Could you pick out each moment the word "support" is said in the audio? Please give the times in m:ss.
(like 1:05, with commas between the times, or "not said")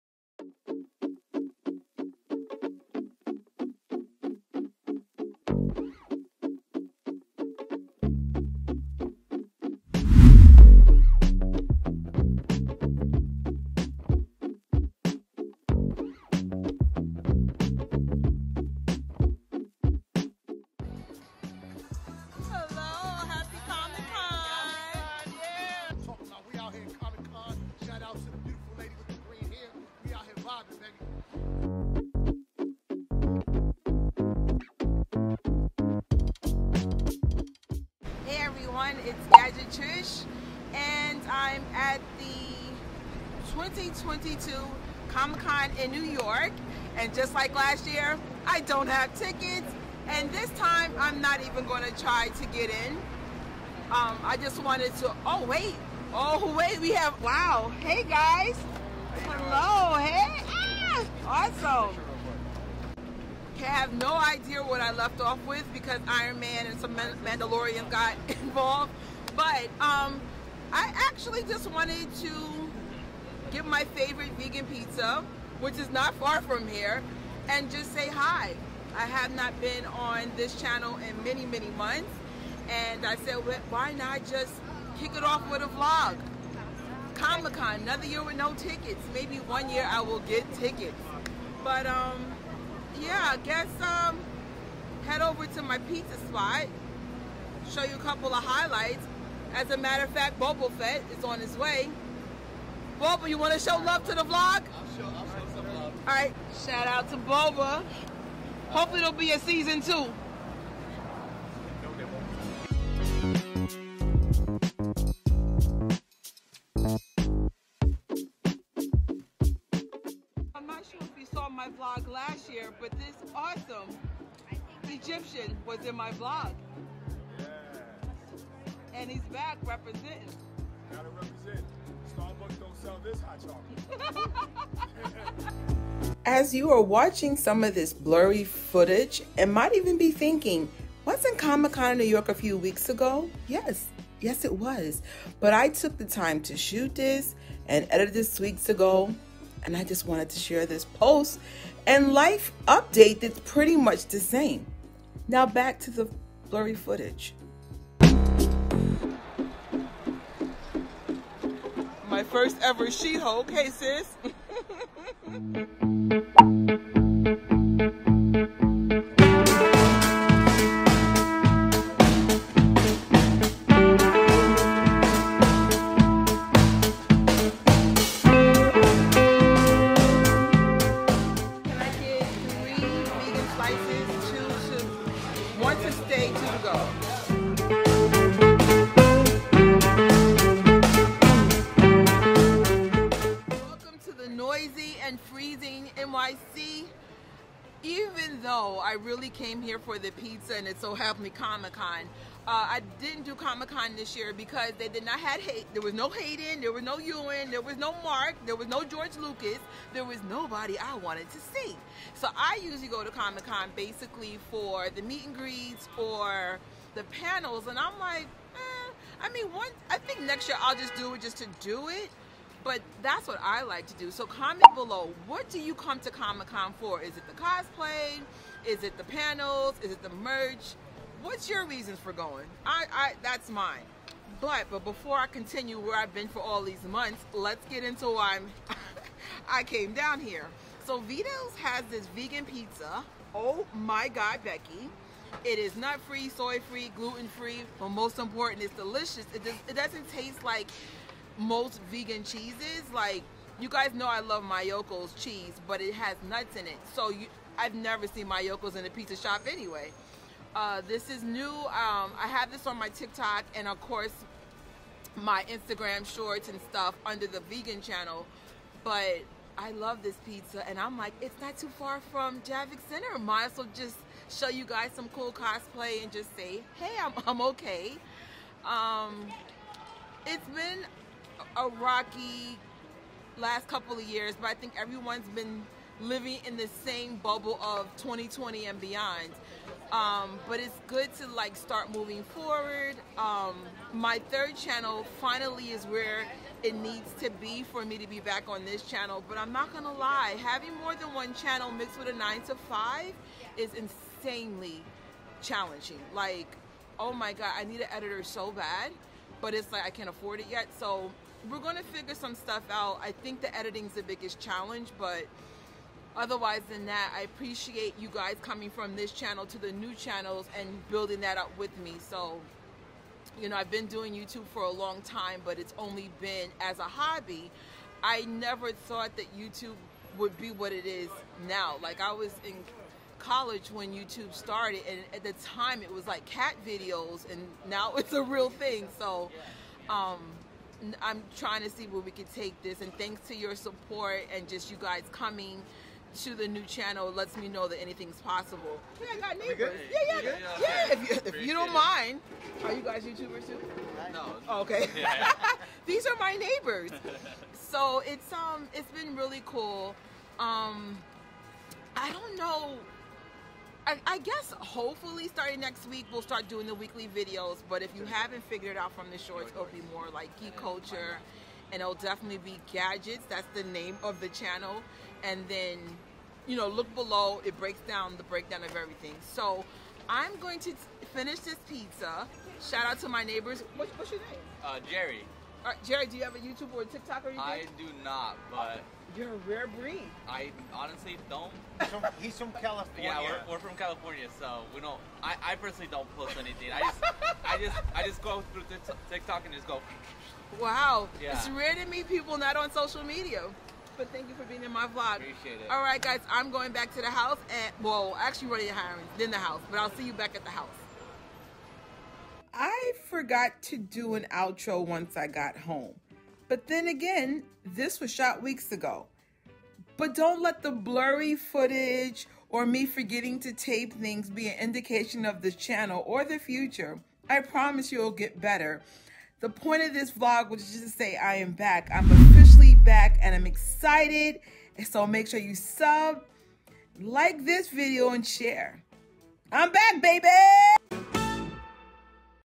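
5:43.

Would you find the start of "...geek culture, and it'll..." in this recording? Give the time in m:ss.
6:10.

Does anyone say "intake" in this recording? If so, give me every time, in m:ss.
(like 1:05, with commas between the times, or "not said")
not said.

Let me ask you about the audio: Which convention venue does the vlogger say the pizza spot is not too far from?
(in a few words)
Javits Center.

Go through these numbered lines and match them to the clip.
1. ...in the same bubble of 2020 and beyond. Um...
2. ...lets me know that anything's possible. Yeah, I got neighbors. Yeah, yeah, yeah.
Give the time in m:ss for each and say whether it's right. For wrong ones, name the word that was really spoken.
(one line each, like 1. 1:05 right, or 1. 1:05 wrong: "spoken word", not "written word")
1. 4:46 right
2. 5:47 right.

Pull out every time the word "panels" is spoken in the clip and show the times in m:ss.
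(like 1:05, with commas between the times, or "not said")
3:37, 3:49.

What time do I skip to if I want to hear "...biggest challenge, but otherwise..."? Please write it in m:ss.
5:14.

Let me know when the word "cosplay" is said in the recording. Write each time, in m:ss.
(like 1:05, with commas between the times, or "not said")
3:47, 4:35.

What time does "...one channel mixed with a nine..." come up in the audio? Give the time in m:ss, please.
5:01.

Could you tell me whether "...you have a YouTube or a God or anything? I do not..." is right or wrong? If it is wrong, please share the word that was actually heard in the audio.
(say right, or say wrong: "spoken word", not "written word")
wrong: "TikTok", not "God".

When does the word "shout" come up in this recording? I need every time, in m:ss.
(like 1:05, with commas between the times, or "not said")
1:46, 6:22.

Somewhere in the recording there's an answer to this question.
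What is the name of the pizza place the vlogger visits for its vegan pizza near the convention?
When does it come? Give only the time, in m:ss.
4:00.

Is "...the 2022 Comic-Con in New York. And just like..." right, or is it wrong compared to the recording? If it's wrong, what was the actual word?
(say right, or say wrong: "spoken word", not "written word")
right.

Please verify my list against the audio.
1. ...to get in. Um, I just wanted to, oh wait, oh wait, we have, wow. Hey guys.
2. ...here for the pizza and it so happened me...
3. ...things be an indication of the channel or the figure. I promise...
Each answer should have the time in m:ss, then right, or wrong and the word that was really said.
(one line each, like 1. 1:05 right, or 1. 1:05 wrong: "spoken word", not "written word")
1. 0:52 right
2. 3:19 right
3. 7:03 wrong: "future", not "figure".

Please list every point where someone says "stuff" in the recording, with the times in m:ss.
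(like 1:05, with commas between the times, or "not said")
4:26, 5:12.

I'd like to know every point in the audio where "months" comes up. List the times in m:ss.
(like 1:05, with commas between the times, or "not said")
1:21, 3:56.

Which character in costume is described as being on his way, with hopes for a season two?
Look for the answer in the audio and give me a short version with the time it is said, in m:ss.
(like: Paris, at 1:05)
Boba Fett, at 1:40.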